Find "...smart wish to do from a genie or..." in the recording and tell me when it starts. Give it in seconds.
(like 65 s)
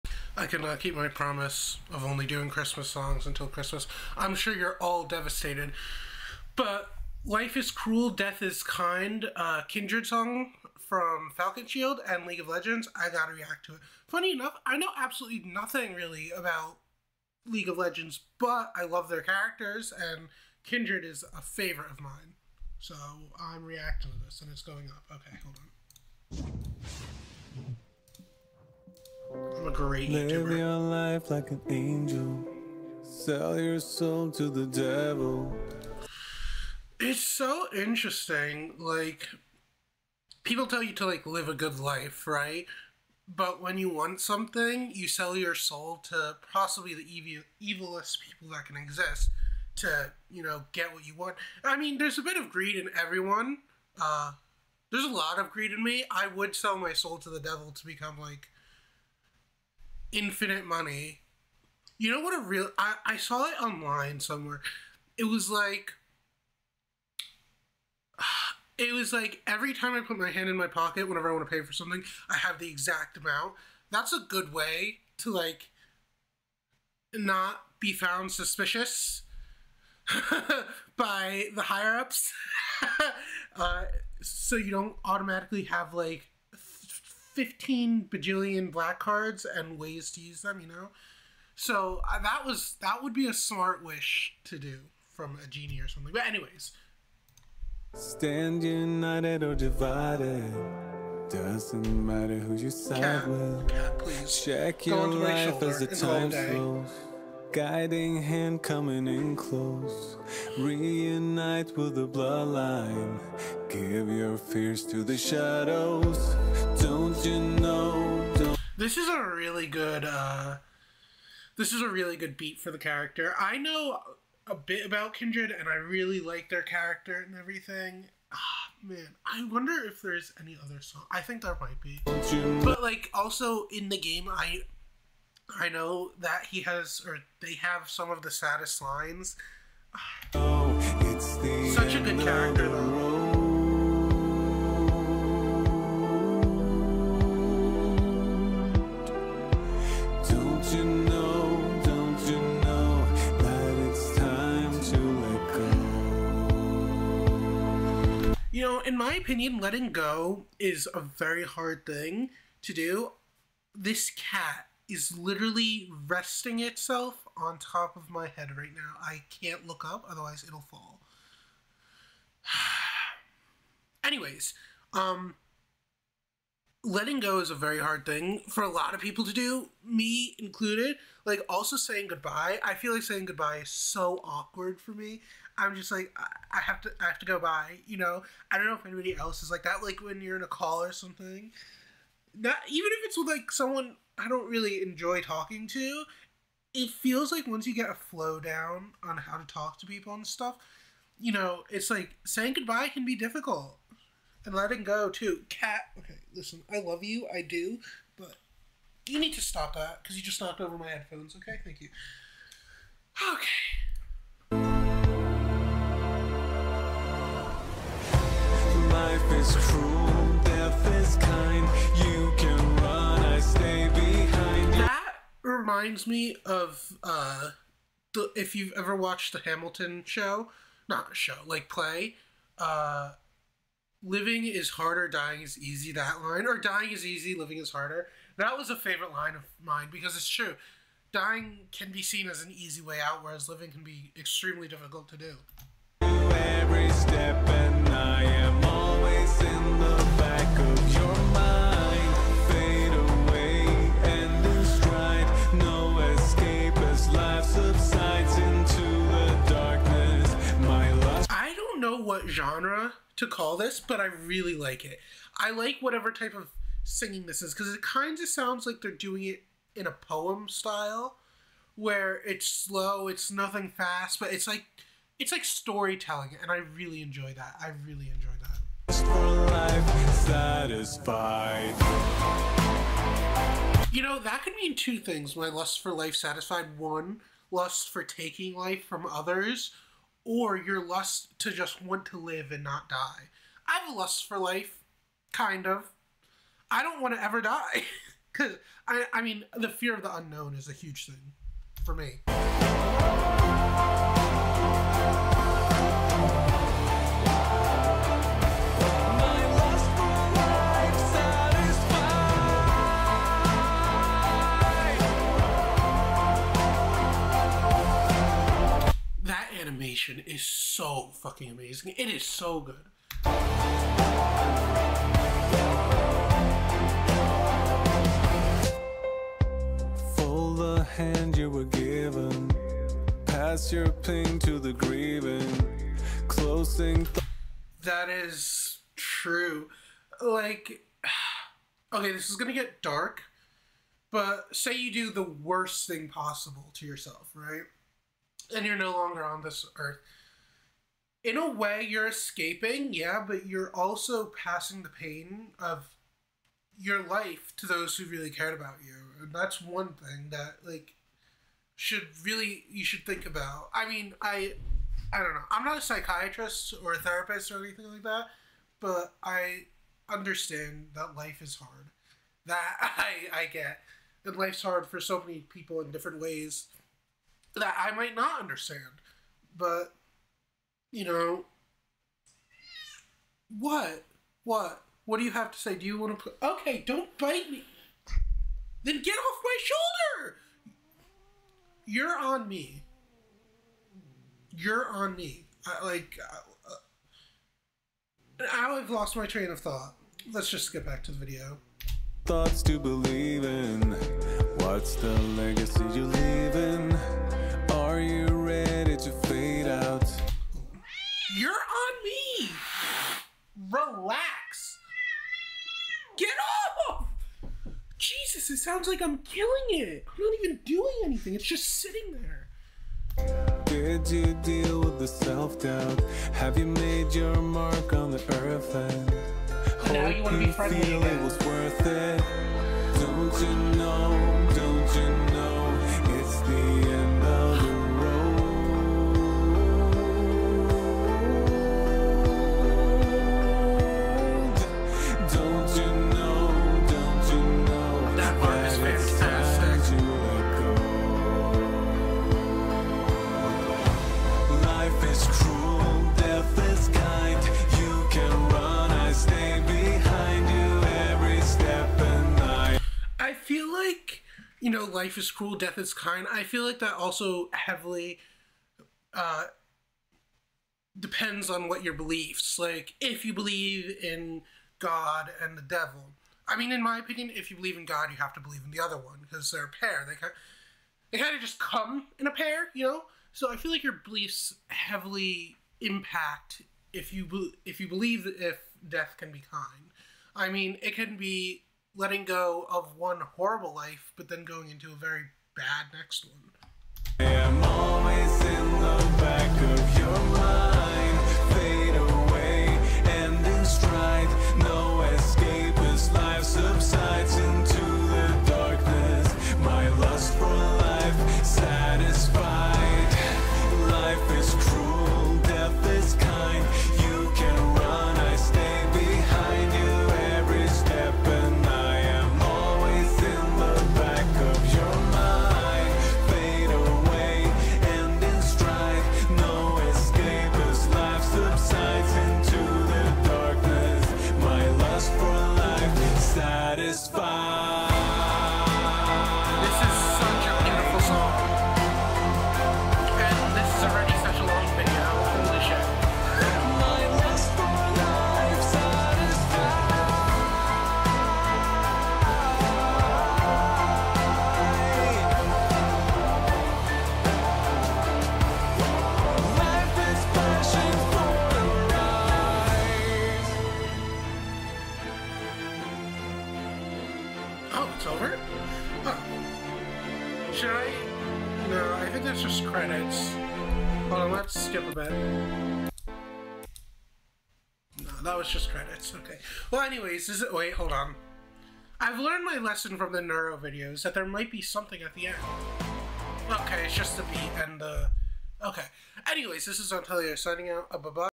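93 s.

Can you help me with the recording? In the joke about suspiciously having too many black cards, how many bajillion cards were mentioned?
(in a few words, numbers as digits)
15.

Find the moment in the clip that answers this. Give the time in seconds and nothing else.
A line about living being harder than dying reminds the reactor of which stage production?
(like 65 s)
229 s.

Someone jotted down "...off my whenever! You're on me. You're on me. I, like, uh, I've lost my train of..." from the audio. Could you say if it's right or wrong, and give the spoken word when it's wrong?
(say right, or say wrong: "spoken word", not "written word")
wrong: "shoulder", not "whenever".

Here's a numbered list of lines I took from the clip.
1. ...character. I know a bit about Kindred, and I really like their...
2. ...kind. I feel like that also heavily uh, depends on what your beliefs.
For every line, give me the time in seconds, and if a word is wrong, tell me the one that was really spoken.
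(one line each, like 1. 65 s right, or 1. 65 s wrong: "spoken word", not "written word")
1. 122 s right
2. 465 s right.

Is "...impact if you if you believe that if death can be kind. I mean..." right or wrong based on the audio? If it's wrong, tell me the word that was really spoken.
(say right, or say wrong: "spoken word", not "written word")
right.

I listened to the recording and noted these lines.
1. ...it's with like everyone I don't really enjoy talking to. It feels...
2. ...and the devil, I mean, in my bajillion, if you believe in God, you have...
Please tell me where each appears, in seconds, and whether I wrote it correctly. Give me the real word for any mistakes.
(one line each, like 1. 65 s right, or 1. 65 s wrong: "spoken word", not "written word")
1. 193 s wrong: "someone", not "everyone"
2. 475 s wrong: "opinion", not "bajillion".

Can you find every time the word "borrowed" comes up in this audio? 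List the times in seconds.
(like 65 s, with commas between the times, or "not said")
not said.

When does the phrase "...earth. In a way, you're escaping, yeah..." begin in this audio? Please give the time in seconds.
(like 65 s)
349 s.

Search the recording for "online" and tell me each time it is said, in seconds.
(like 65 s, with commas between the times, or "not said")
63 s.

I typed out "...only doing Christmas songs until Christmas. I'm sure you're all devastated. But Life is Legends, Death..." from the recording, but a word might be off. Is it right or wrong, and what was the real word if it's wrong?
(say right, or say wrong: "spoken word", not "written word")
wrong: "Cruel", not "Legends".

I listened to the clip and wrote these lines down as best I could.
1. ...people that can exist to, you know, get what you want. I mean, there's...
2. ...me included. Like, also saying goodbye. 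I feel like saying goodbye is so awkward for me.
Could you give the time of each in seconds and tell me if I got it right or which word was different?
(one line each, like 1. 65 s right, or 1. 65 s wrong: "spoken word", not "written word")
1. 48 s right
2. 179 s right.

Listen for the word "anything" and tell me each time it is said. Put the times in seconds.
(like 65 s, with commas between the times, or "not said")
367 s, 421 s.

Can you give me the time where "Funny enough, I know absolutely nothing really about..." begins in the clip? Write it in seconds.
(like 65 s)
14 s.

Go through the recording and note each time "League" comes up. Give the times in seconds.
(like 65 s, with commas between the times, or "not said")
12 s, 17 s.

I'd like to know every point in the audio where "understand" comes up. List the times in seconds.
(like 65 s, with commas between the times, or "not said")
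370 s, 378 s.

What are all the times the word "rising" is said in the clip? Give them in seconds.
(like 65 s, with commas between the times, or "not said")
not said.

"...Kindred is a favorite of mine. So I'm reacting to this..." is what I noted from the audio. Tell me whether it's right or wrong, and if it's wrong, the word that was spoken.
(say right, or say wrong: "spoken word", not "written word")
right.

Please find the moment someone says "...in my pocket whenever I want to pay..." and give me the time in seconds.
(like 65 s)
70 s.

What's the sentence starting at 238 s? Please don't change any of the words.
That was a favorite line of mine because it's true.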